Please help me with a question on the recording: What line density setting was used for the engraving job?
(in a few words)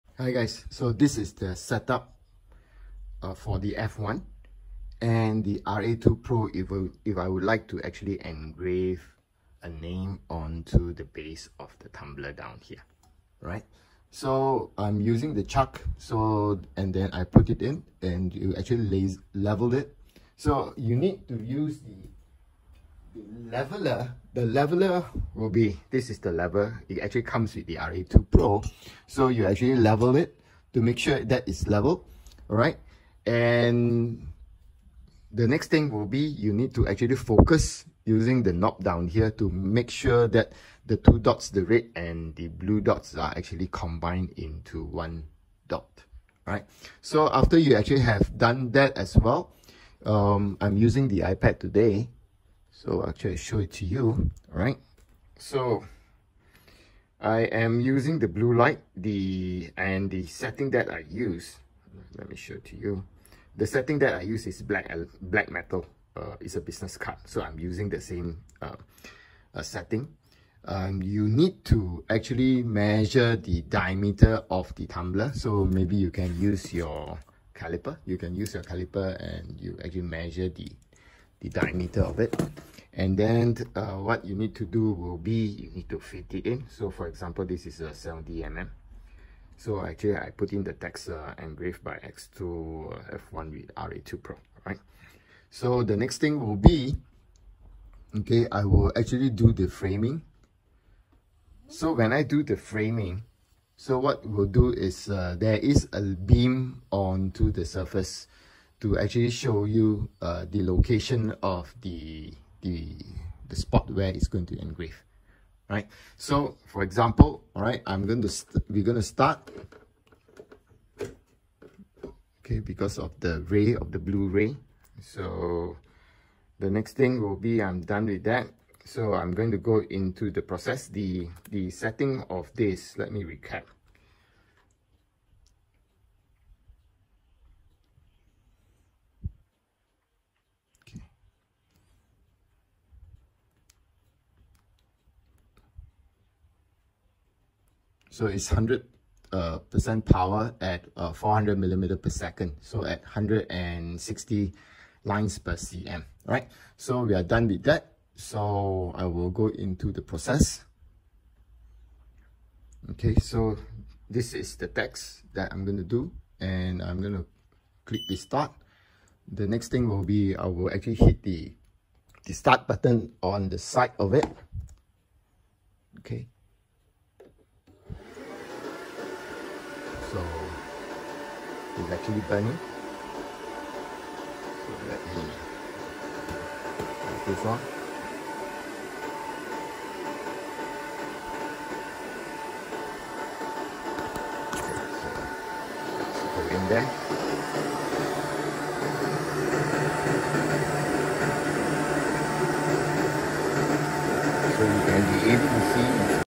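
160 lines per cm.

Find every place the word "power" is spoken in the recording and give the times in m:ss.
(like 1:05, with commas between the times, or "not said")
2:30.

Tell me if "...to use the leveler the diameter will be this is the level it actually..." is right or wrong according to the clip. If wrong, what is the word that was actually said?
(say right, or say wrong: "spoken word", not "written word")
wrong: "leveler", not "diameter".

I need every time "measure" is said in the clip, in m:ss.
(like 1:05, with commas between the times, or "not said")
1:12, 1:20.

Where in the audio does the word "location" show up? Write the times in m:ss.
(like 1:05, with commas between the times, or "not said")
1:50.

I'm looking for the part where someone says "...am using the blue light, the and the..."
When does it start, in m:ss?
0:57.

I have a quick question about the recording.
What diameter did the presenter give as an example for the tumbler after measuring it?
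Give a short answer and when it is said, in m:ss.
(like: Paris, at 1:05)
70 mm, at 1:27.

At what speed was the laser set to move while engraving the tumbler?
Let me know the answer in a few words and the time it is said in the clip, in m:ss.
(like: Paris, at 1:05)
400 mm/s, at 2:31.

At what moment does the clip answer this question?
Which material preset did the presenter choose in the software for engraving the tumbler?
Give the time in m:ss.
1:05.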